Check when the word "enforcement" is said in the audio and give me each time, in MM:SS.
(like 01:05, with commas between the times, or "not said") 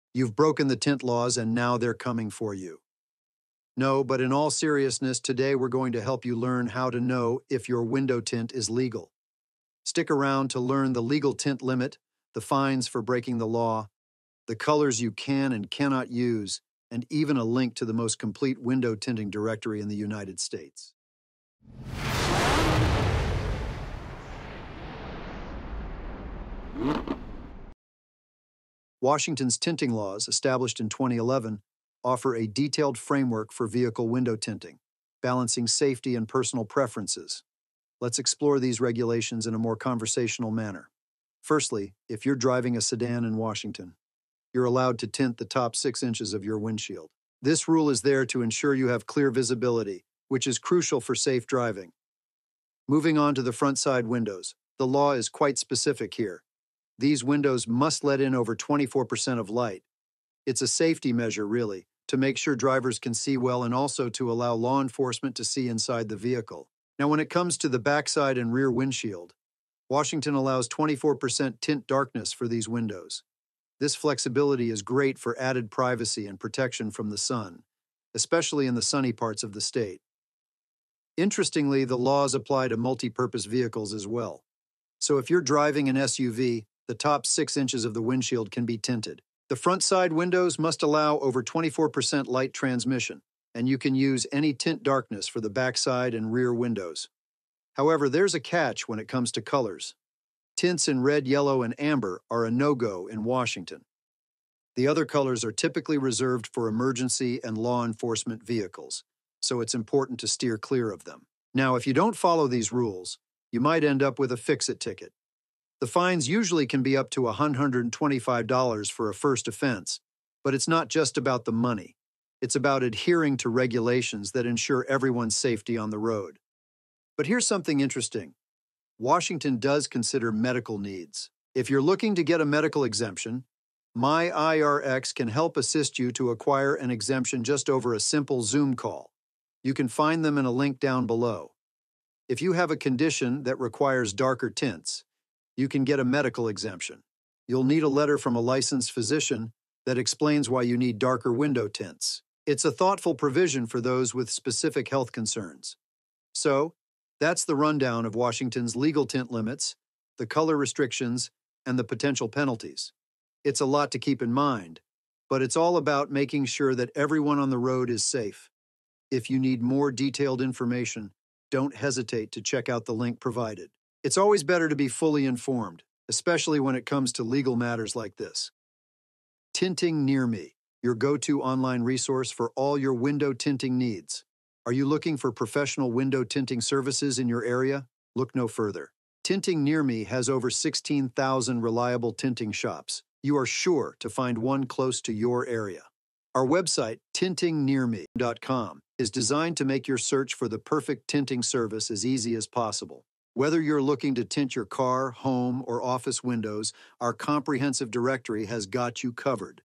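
01:04, 01:47.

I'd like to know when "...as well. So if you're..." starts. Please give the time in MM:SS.
01:23.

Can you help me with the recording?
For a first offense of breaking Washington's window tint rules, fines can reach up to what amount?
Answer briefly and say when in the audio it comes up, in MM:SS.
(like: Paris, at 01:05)
$125, at 01:57.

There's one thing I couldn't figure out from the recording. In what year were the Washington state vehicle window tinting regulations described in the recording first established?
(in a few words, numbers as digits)
2011.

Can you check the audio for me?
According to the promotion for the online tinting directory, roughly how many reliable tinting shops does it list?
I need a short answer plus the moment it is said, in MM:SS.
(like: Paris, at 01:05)
over 16,000, at 03:10.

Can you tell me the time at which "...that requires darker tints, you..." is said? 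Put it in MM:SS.
02:23.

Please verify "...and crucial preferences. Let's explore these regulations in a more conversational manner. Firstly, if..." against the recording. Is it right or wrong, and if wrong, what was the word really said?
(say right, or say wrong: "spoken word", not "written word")
wrong: "personal", not "crucial".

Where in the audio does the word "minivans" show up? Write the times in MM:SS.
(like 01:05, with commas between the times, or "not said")
not said.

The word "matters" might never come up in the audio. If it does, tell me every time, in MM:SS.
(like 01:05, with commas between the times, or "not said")
02:57.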